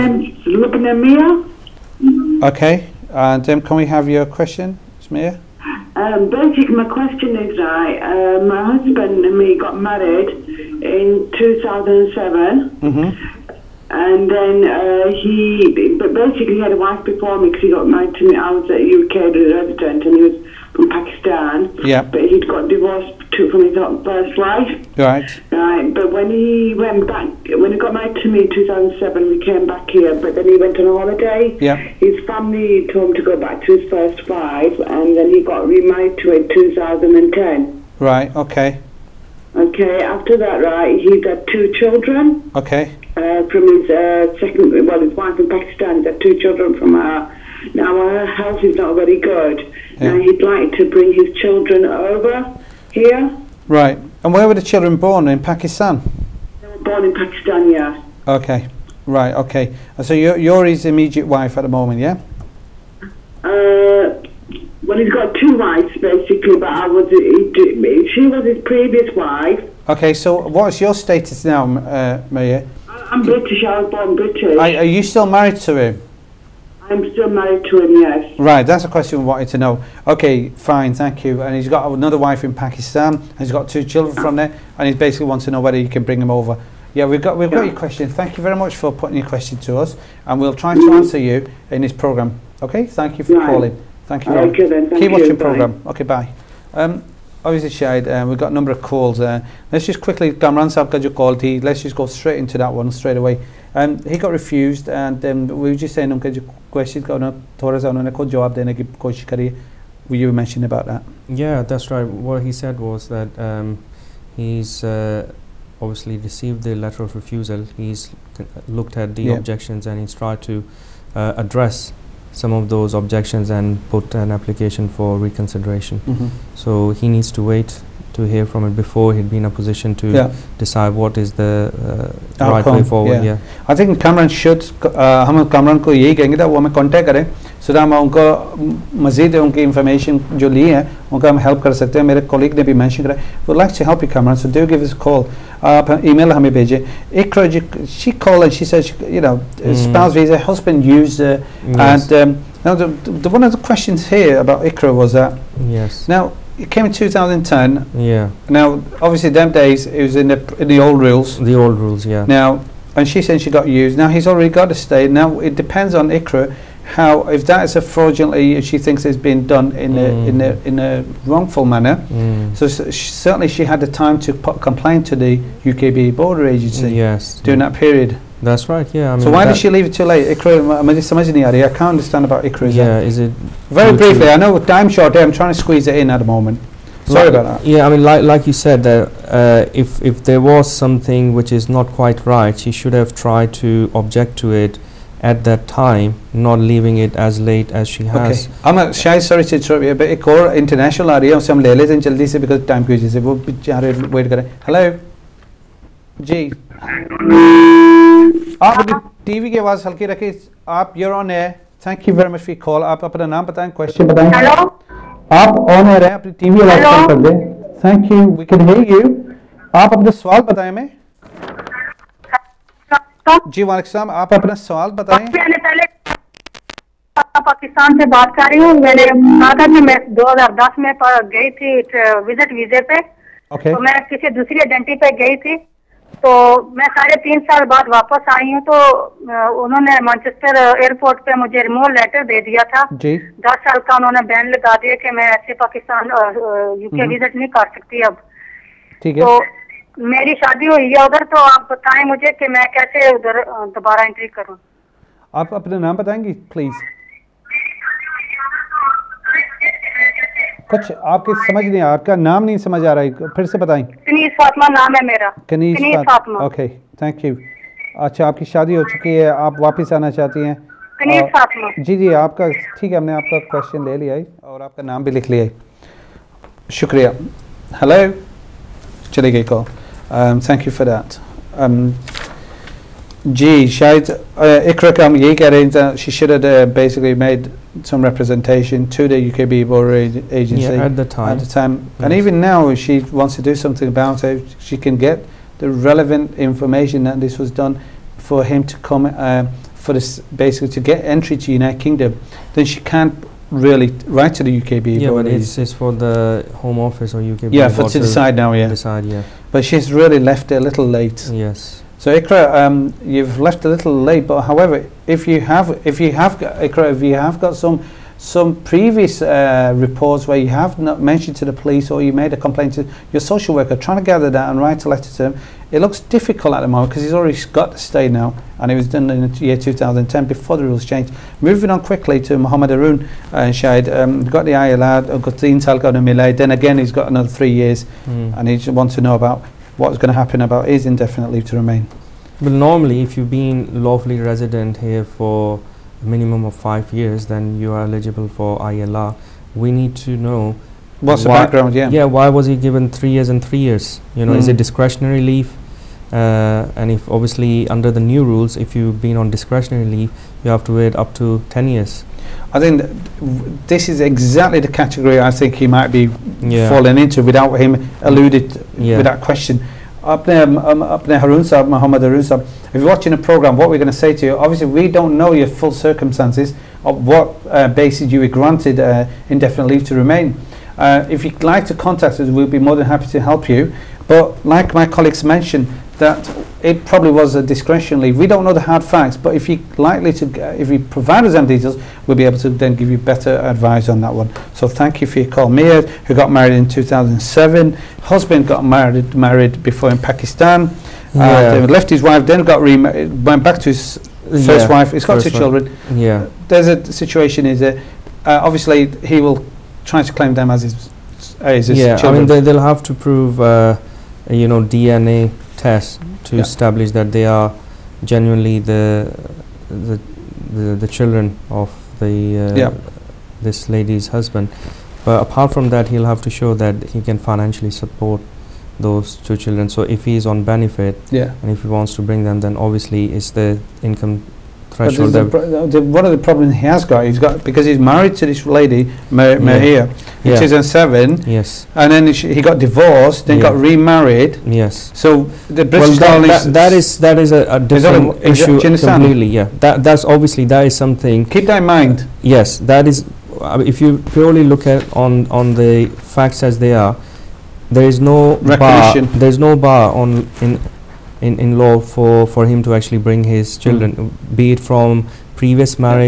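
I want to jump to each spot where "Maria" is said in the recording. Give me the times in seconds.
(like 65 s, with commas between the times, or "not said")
72 s, 439 s.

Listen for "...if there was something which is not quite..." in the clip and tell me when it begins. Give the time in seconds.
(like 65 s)
189 s.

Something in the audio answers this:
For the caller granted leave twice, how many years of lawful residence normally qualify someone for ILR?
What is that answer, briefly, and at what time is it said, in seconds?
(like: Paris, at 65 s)
5, at 346 s.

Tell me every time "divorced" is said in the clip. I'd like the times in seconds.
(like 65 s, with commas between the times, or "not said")
22 s, 442 s.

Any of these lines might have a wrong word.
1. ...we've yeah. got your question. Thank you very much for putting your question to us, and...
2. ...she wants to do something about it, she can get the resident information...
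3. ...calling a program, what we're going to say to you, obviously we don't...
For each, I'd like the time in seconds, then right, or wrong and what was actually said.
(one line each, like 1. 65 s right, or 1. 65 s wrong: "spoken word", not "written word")
1. 87 s right
2. 292 s wrong: "relevant", not "resident"
3. 372 s wrong: "watching", not "calling".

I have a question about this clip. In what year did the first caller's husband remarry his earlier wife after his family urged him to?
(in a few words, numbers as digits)
2010.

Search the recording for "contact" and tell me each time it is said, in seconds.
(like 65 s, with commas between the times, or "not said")
136 s, 381 s.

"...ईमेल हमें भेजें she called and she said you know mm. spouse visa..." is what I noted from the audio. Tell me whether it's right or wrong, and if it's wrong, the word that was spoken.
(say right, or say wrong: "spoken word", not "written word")
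right.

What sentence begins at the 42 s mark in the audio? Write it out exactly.
Okay uh, from his uh, second, well, his wife in Pakistan.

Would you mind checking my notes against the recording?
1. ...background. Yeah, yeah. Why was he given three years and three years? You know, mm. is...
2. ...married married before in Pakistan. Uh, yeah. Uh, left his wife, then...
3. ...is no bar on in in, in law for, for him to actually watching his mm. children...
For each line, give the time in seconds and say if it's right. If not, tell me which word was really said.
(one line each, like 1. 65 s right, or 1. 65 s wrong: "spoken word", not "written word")
1. 351 s right
2. 398 s right
3. 459 s wrong: "bring", not "watching".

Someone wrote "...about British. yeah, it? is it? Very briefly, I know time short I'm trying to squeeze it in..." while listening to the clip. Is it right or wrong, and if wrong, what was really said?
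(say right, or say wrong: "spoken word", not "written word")
wrong: "Ikra", not "British".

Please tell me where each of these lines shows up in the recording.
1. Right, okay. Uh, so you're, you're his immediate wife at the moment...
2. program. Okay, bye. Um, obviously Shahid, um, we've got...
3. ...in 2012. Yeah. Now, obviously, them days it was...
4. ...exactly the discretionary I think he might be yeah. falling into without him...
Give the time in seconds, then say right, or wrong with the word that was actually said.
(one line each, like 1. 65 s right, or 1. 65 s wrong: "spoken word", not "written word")
1. 59 s right
2. 95 s right
3. 156 s wrong: "2010", not "2012"
4. 363 s wrong: "category", not "discretionary".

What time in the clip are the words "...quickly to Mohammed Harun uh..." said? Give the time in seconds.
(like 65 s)
331 s.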